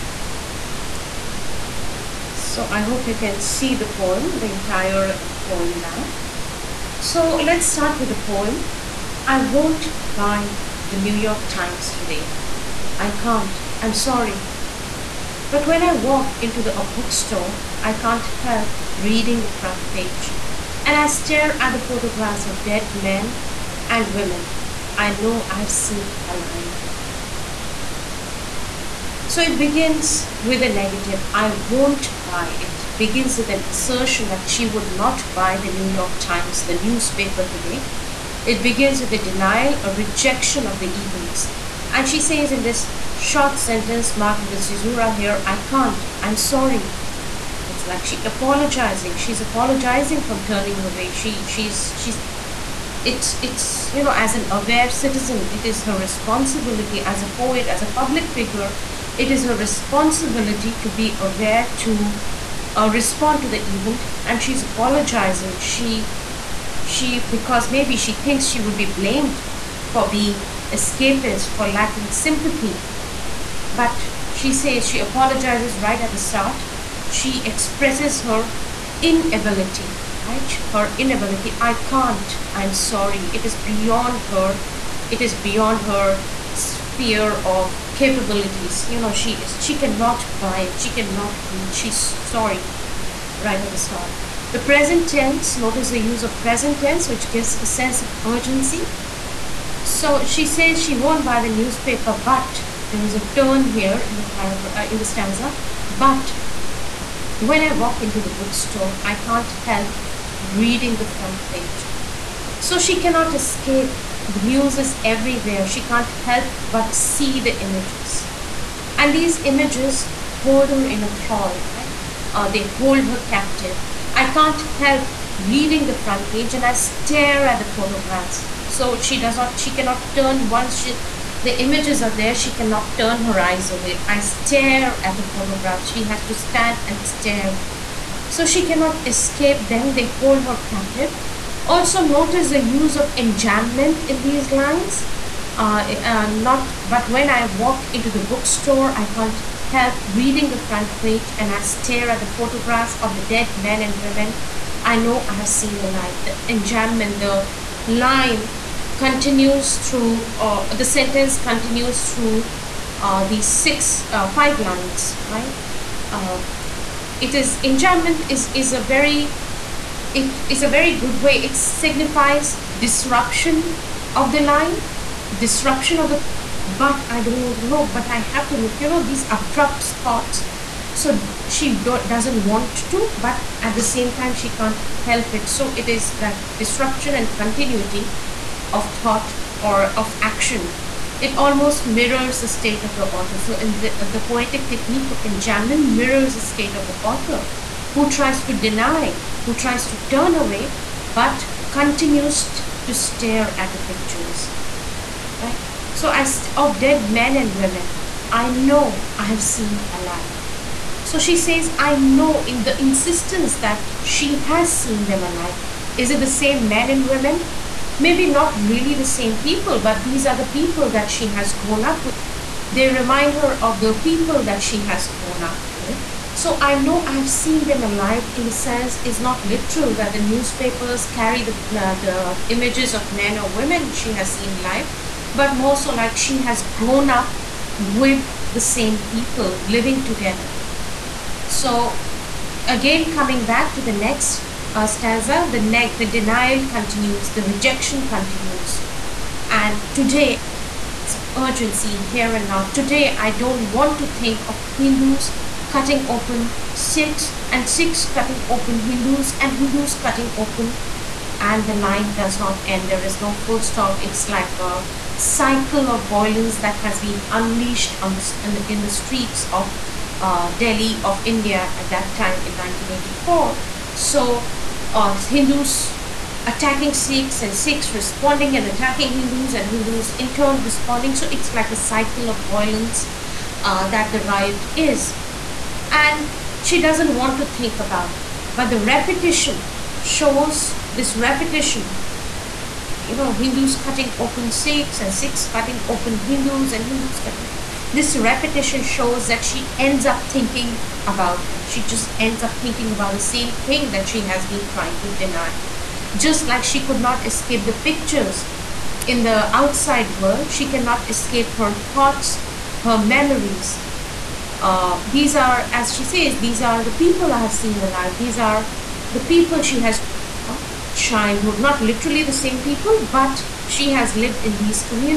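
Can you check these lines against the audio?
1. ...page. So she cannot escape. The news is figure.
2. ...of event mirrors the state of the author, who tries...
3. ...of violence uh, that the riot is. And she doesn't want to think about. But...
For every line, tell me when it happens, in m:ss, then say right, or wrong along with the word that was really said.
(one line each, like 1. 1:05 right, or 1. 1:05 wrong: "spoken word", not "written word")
1. 1:51 wrong: "everywhere", not "figure"
2. 3:15 wrong: "enjambment", not "event"
3. 4:42 right.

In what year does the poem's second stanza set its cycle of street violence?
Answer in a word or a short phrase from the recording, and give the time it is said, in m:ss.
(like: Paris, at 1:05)
1984, at 4:32.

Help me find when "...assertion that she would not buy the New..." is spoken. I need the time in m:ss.
0:33.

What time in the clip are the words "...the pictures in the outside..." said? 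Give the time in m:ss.
5:07.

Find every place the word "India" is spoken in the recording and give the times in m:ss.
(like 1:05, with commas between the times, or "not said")
4:31.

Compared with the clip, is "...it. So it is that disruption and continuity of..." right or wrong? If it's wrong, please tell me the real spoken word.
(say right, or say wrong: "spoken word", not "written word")
right.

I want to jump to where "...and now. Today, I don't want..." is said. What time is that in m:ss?
4:12.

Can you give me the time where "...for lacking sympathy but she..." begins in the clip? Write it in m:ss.
1:11.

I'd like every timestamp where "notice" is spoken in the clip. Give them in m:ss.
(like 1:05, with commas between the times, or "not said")
1:35, 2:22.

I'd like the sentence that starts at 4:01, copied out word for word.
So again, coming back to the next a uh, stanza, the, the denial continues, the rejection continues.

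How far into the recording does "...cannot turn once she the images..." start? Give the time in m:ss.
2:09.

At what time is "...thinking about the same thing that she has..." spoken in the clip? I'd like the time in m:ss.
5:02.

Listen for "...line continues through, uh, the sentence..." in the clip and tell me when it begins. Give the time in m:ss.
2:37.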